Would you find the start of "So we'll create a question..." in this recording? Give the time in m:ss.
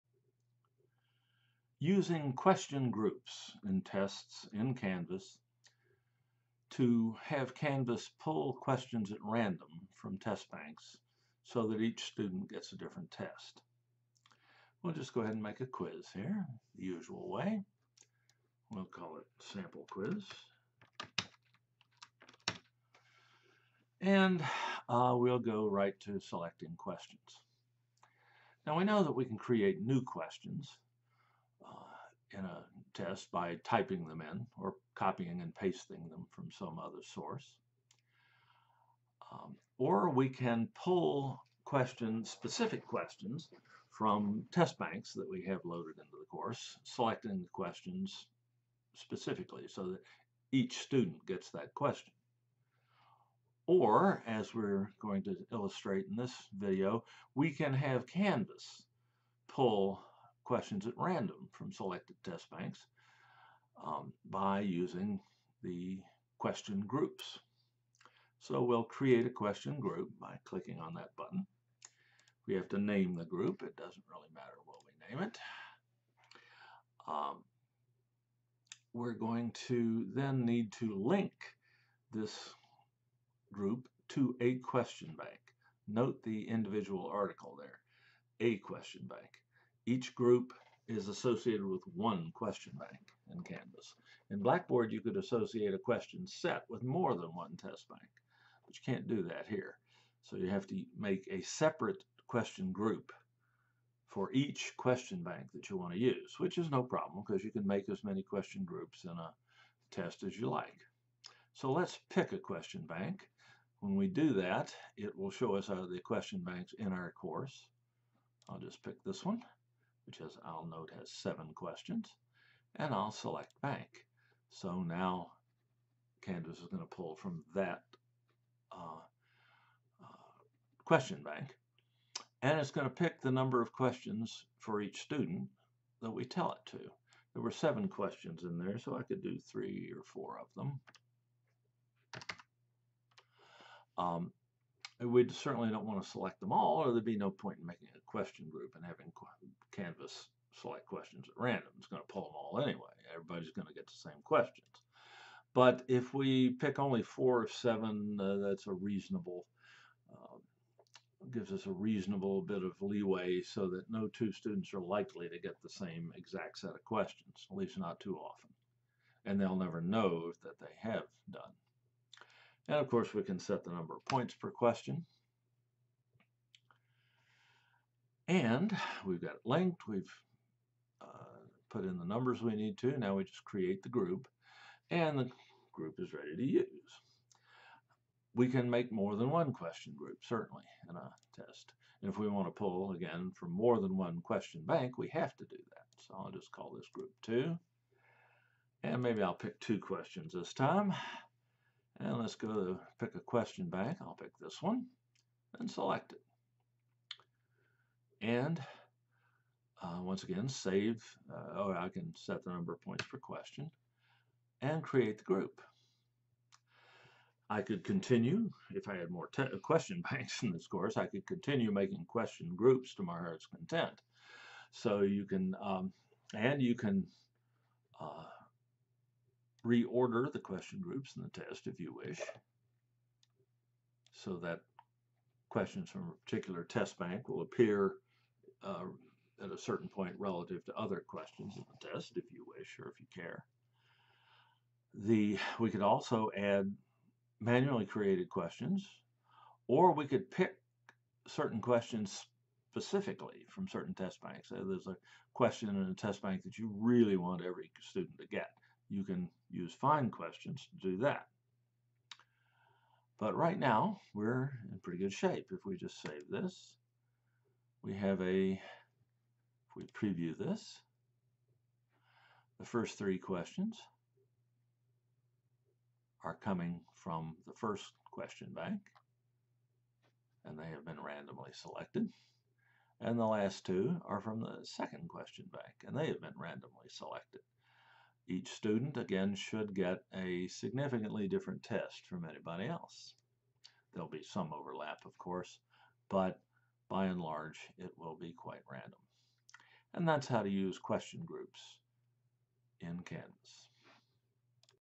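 1:08.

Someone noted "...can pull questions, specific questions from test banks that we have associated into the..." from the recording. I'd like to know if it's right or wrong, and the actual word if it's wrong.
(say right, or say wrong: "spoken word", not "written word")
wrong: "loaded", not "associated".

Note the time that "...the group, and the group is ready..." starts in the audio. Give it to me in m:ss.
3:03.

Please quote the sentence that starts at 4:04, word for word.
The We could also add manually created questions or we could pick certain questions specifically from certain test banks.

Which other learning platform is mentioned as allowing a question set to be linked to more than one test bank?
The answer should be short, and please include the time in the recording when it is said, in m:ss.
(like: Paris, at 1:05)
Blackboard, at 1:34.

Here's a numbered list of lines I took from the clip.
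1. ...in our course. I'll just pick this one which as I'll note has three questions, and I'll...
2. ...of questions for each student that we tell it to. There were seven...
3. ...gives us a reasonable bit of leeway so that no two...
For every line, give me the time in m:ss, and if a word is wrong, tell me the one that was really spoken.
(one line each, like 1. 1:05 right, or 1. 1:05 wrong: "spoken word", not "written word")
1. 1:56 wrong: "seven", not "three"
2. 2:13 right
3. 2:41 right.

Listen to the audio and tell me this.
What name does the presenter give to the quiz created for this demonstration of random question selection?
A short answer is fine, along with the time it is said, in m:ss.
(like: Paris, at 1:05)
sample quiz, at 0:19.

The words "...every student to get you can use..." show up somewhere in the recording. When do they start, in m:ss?
4:17.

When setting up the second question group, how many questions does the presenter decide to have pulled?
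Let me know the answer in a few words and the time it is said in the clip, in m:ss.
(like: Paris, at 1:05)
2, at 3:19.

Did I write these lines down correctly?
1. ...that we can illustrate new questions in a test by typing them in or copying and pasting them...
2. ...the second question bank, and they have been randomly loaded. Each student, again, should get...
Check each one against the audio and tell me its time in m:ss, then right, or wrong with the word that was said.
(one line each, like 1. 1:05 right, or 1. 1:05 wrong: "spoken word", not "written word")
1. 0:29 wrong: "create", not "illustrate"
2. 4:44 wrong: "selected", not "loaded".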